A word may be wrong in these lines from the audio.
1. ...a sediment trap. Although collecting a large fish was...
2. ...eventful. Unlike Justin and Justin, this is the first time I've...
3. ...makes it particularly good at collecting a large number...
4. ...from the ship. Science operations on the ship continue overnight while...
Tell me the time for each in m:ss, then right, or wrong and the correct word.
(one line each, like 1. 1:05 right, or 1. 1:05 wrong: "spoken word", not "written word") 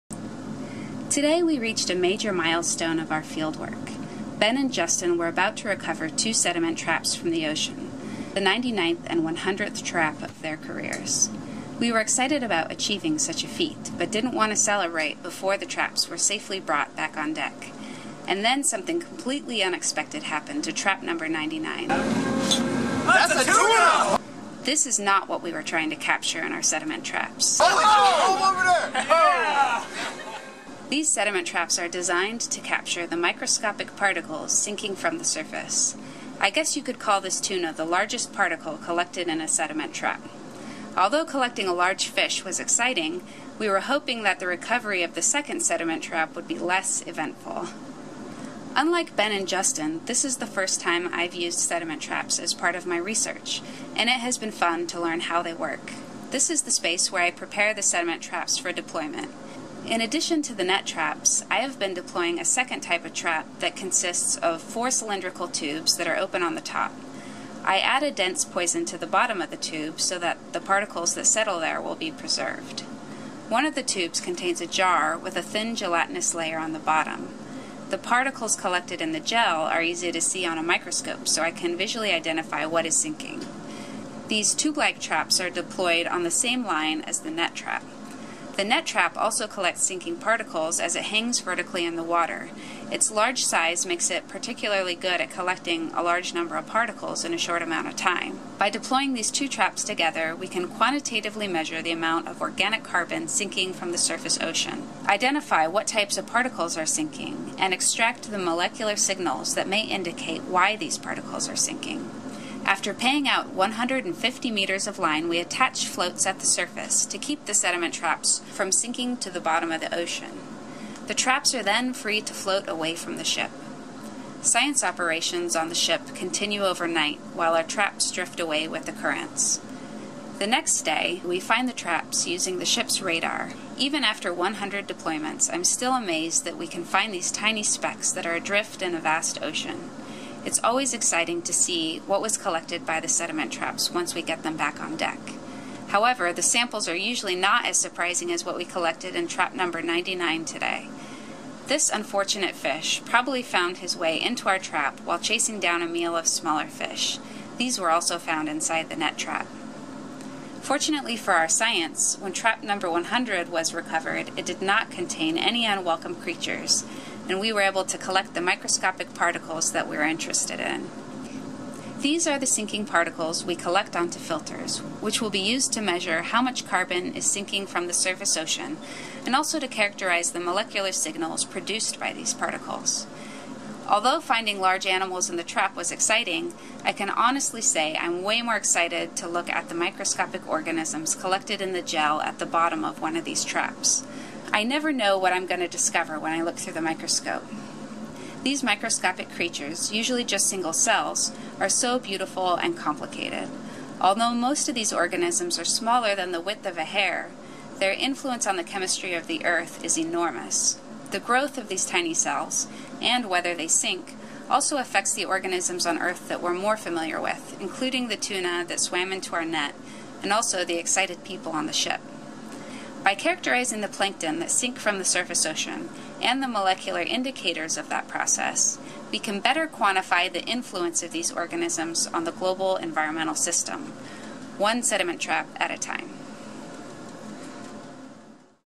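1. 0:39 right
2. 0:47 wrong: "Ben", not "Justin"
3. 1:33 right
4. 2:02 right.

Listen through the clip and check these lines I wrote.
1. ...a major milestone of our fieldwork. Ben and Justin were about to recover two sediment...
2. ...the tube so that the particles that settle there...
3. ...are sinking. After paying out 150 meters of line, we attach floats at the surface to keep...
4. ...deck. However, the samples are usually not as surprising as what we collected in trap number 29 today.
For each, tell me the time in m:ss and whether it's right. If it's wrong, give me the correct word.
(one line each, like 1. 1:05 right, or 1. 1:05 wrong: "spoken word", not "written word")
1. 0:01 right
2. 1:09 right
3. 1:51 right
4. 2:24 wrong: "99", not "29".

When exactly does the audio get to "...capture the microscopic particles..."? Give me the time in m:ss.
0:32.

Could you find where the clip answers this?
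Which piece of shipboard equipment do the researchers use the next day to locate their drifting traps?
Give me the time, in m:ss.
2:12.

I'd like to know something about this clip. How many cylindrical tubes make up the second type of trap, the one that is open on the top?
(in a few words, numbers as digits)
4.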